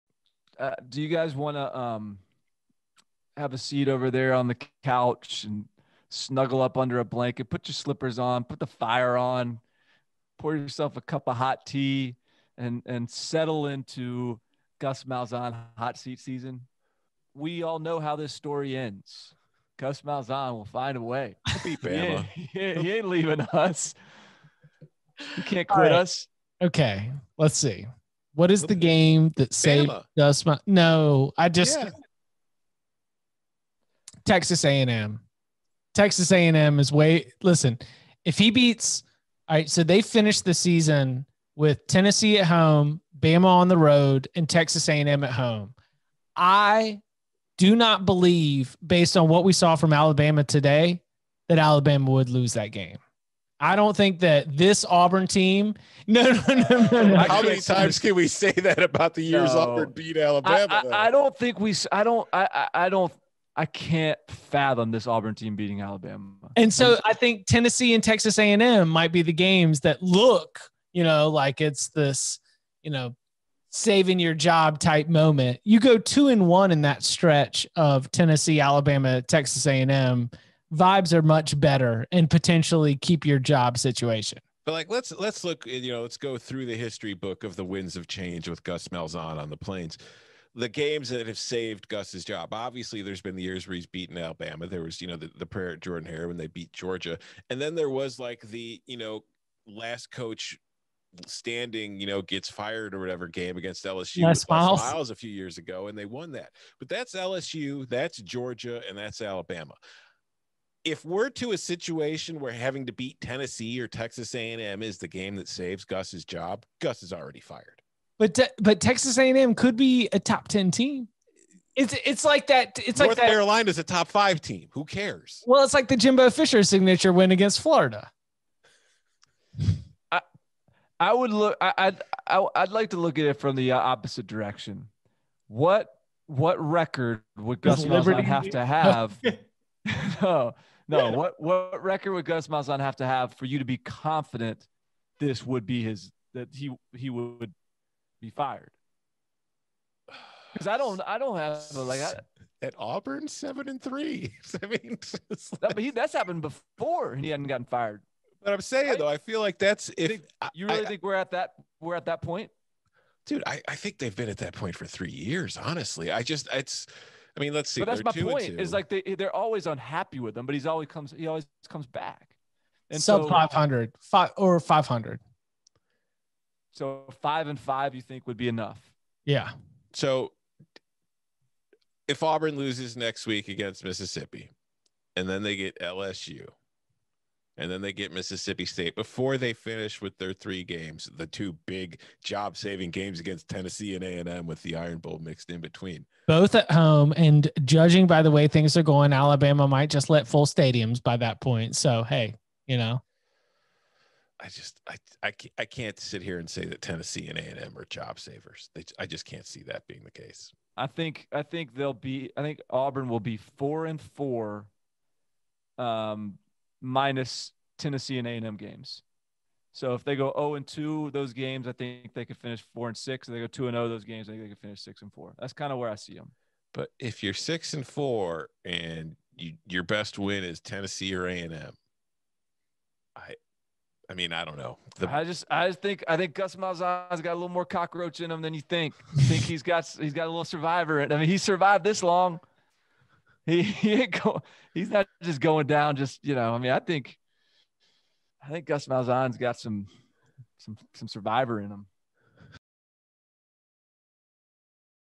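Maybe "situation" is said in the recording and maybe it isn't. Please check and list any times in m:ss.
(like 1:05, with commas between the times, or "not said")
1:23, 1:51.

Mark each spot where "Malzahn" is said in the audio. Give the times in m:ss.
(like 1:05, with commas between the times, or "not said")
0:15, 0:20, 1:28, 2:17, 2:22, 3:56, 4:08.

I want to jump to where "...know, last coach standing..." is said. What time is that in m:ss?
1:38.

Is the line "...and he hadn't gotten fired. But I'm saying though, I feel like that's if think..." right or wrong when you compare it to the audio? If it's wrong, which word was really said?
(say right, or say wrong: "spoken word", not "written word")
right.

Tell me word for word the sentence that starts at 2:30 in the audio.
Because I don't I don't have like I, at Auburn seven and three.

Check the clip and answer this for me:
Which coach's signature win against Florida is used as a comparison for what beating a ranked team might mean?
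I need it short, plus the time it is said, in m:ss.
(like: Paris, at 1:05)
Jimbo Fisher, at 2:05.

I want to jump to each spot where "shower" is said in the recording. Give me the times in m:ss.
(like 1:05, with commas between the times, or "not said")
not said.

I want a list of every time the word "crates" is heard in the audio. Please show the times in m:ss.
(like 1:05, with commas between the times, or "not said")
not said.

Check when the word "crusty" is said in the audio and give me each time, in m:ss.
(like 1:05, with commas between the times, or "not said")
not said.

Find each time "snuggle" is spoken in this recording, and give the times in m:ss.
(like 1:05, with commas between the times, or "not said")
0:06.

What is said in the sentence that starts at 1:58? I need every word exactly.
But te- but Texas A&M could be a top 10 team.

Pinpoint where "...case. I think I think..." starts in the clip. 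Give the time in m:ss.
3:30.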